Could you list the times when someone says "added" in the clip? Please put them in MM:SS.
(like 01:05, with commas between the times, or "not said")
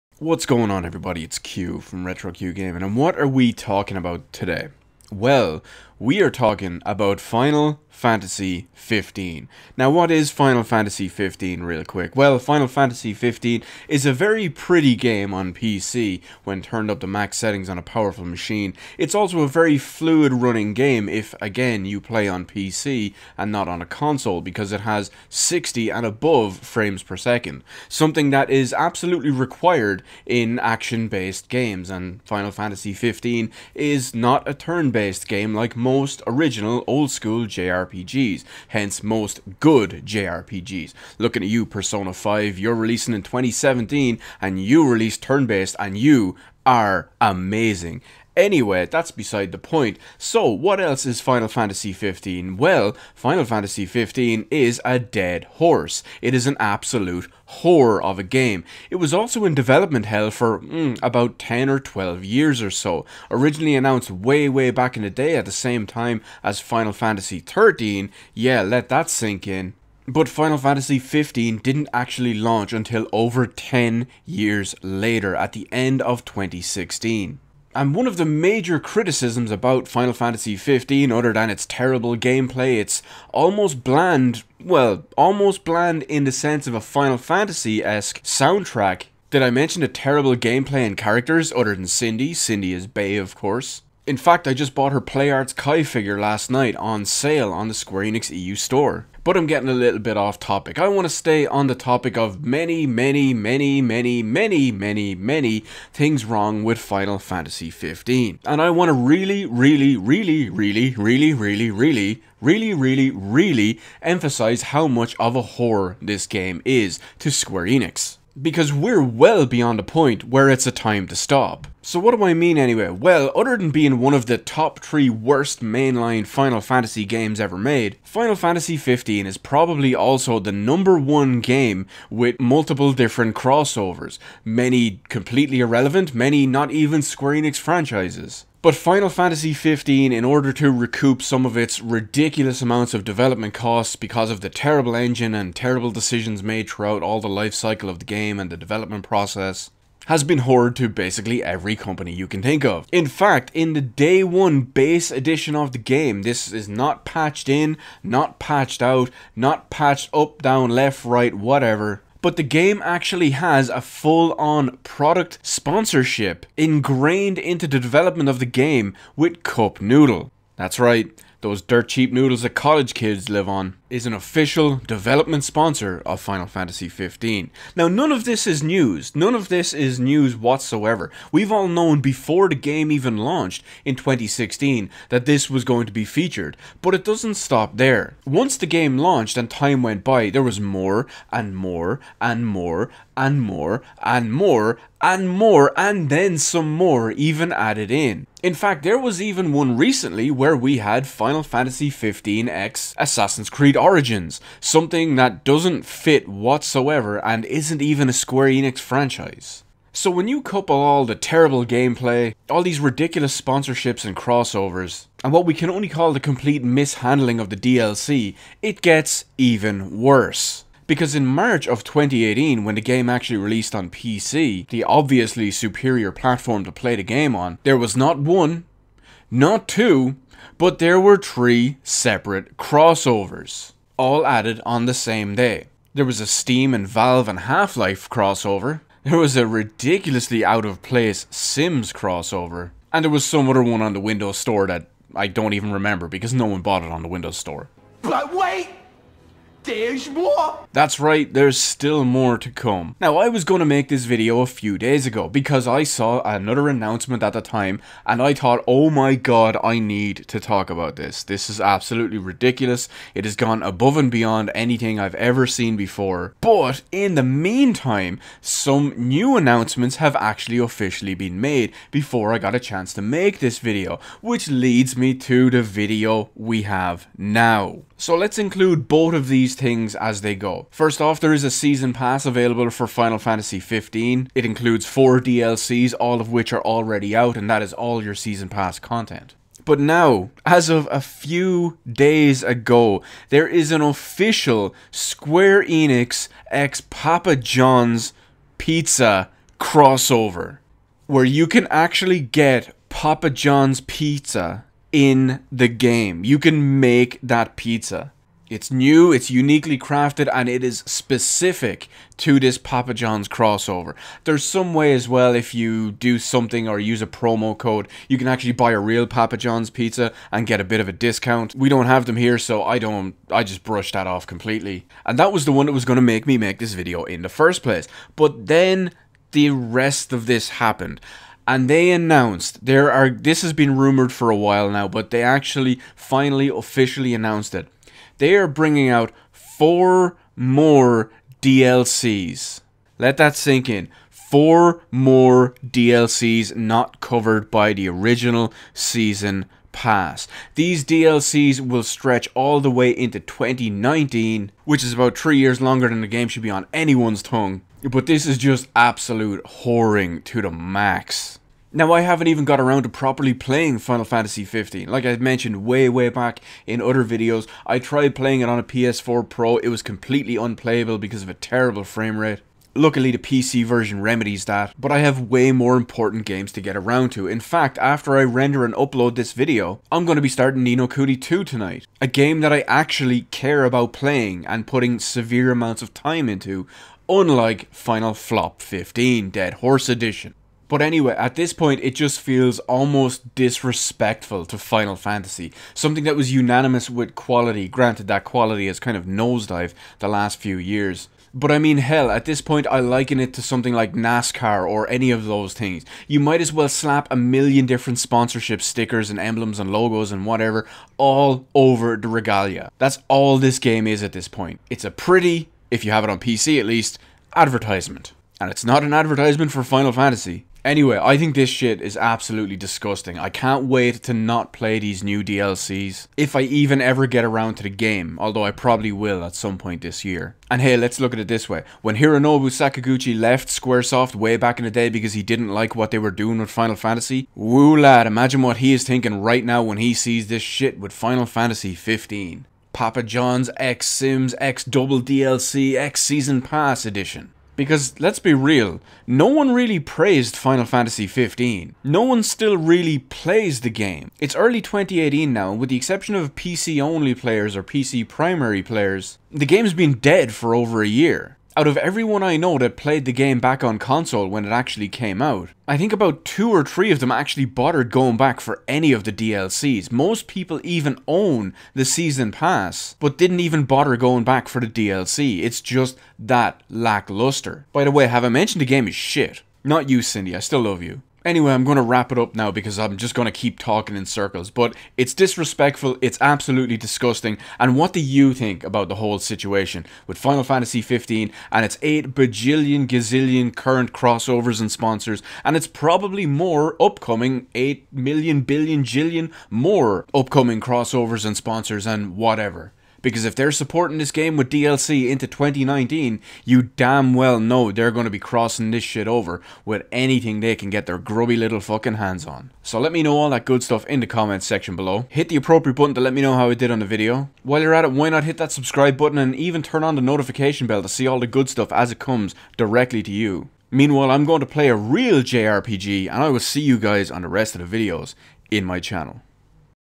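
03:17, 03:54.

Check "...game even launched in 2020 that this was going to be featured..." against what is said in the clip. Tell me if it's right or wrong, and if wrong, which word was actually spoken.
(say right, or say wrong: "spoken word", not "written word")
wrong: "2016", not "2020".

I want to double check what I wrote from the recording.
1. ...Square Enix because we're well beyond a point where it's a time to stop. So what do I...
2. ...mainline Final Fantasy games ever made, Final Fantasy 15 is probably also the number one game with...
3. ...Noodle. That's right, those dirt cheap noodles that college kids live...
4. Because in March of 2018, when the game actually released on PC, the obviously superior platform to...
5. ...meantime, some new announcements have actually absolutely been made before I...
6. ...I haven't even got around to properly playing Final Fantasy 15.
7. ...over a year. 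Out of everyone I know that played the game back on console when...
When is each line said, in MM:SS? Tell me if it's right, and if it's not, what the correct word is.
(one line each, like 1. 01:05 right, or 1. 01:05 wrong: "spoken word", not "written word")
1. 01:57 right
2. 02:05 right
3. 02:49 right
4. 03:40 right
5. 04:27 wrong: "officially", not "absolutely"
6. 06:01 right
7. 07:40 right.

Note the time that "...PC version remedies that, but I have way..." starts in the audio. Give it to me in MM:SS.
06:13.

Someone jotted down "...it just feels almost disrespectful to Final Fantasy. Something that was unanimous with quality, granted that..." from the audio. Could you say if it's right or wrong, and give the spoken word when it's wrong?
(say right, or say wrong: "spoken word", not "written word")
right.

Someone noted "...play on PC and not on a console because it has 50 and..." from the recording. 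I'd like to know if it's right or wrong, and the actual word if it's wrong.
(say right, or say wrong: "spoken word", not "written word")
wrong: "60", not "50".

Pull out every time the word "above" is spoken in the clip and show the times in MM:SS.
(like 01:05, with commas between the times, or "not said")
00:26, 04:23.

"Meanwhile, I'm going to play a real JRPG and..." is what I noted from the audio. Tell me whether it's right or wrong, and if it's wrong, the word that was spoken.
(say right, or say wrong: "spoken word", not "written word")
right.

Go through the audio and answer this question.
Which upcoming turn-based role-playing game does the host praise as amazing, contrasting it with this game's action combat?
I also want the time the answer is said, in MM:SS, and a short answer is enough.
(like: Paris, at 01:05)
Persona 5, at 00:41.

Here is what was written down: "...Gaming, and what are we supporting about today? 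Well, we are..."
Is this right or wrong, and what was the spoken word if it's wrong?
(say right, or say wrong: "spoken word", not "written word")
wrong: "talking", not "supporting".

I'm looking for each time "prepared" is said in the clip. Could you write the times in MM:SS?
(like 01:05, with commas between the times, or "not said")
not said.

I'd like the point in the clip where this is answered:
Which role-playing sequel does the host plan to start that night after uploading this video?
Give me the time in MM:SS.
06:20.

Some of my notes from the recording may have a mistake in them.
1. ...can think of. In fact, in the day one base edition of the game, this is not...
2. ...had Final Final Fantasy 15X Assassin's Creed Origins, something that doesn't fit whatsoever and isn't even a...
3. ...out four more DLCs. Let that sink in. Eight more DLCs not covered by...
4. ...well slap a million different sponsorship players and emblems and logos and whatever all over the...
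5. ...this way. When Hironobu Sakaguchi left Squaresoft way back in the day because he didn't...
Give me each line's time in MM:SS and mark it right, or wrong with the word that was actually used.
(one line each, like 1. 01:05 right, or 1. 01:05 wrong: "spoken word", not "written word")
1. 02:32 right
2. 03:20 right
3. 05:38 wrong: "Four", not "Eight"
4. 06:46 wrong: "stickers", not "players"
5. 07:11 right.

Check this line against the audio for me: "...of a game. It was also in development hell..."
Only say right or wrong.
right.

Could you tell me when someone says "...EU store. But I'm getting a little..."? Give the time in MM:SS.
01:38.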